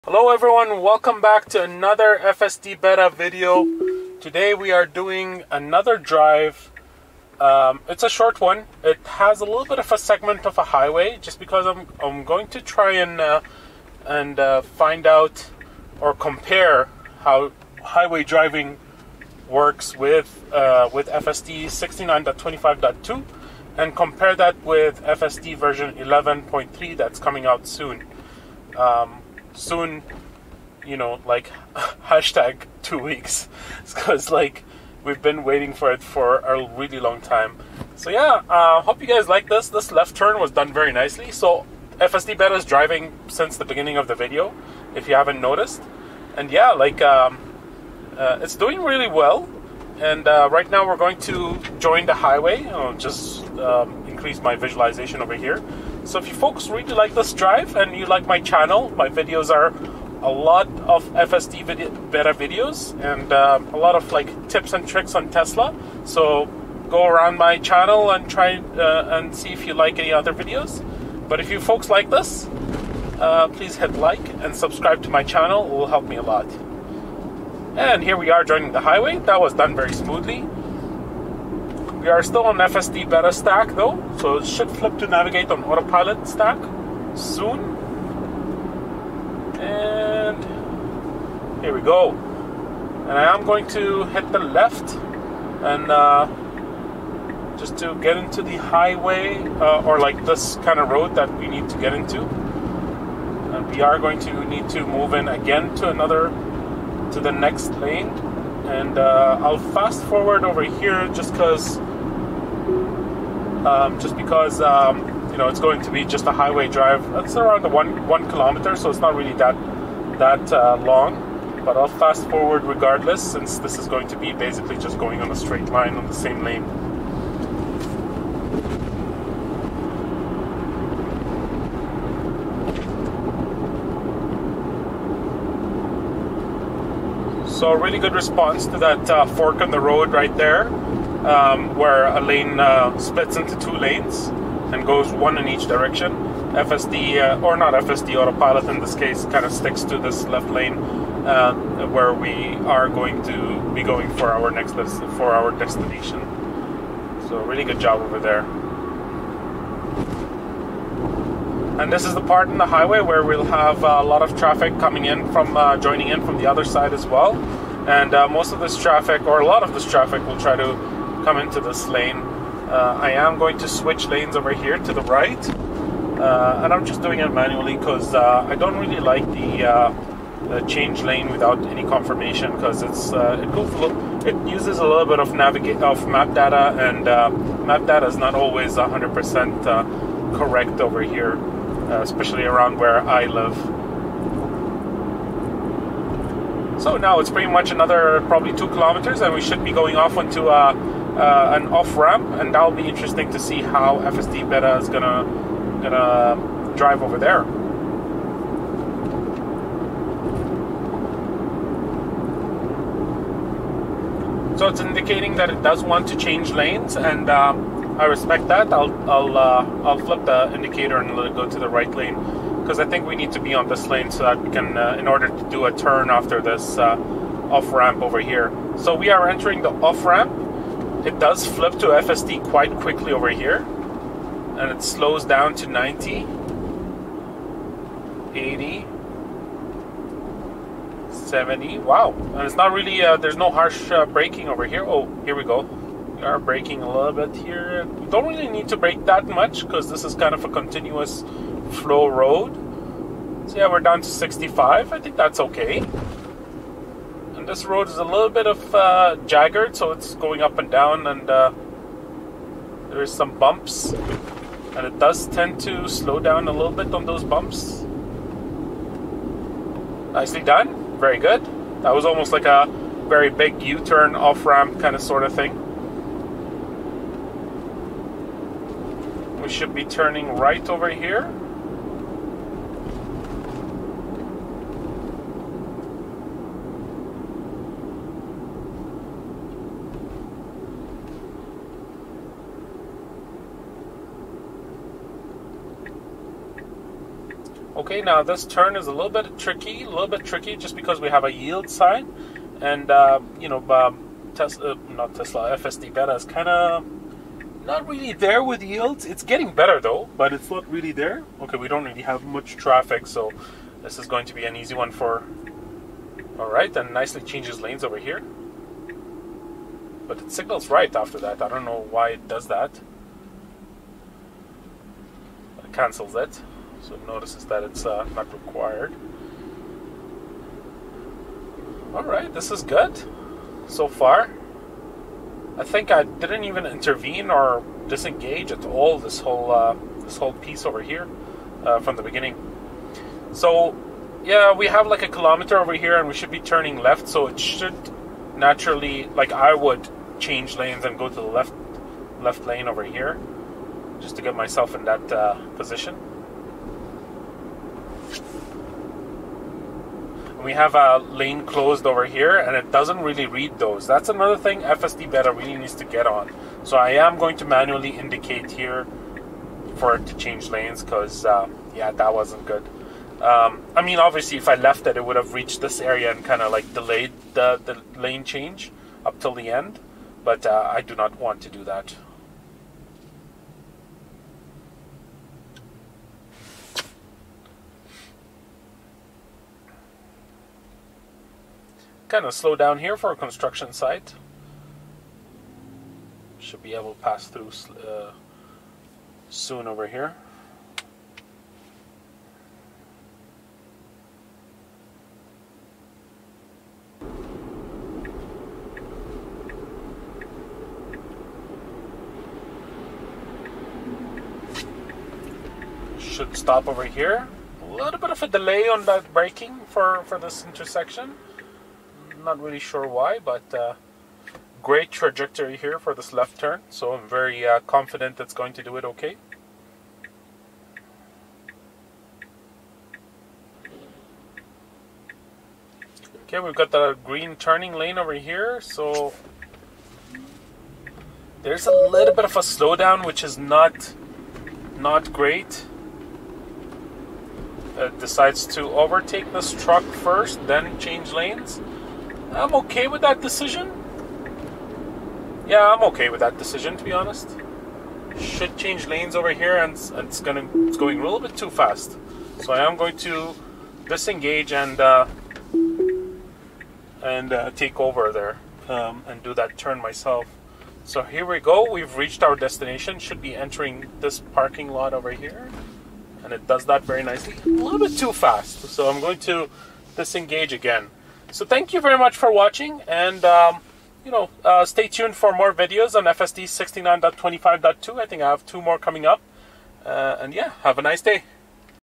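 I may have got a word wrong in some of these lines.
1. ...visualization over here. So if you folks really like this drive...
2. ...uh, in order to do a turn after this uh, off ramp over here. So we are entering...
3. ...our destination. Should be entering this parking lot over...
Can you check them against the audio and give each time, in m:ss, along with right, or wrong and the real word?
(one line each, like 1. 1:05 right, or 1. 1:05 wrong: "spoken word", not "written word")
1. 0:54 right
2. 3:44 right
3. 7:52 right.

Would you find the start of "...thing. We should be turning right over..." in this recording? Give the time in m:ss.
4:35.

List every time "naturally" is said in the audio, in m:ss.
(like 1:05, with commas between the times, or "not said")
5:48.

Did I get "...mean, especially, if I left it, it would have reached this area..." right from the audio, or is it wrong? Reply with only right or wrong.
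wrong.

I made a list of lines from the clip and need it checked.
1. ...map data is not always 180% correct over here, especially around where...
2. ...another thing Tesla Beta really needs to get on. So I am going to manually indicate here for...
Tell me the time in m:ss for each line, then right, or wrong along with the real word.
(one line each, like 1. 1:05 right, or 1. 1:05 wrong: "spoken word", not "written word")
1. 3:07 wrong: "100", not "180"
2. 6:04 wrong: "FSD", not "Tesla".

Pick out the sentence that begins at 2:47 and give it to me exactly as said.
And uh, most of this traffic, or a lot of this traffic, will try to come into this lane.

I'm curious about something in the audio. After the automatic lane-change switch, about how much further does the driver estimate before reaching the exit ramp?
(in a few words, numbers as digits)
2 kilometers.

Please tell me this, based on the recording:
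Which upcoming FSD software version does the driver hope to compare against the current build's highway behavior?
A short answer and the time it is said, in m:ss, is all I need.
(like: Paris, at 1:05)
11.3, at 0:25.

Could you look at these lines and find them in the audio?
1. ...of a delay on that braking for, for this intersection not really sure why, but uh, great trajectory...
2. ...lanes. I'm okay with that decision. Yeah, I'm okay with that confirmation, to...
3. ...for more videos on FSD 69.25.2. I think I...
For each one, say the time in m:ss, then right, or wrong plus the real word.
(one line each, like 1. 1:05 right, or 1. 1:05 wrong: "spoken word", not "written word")
1. 6:58 right
2. 7:31 wrong: "decision", not "confirmation"
3. 8:05 right.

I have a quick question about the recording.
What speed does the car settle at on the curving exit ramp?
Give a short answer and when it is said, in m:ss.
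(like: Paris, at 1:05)
65, at 4:14.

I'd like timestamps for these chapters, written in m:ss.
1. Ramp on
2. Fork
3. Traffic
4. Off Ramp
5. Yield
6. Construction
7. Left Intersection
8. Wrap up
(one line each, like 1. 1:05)
1. 1:00
2. 2:00
3. 2:40
4. 3:30
5. 5:00
6. 6:00
7. 7:00
8. 8:00.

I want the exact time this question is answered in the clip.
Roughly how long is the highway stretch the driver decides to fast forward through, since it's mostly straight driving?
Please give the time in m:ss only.
1:57.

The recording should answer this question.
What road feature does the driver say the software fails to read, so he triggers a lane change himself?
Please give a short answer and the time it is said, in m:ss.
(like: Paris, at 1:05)
lane closed, at 6:00.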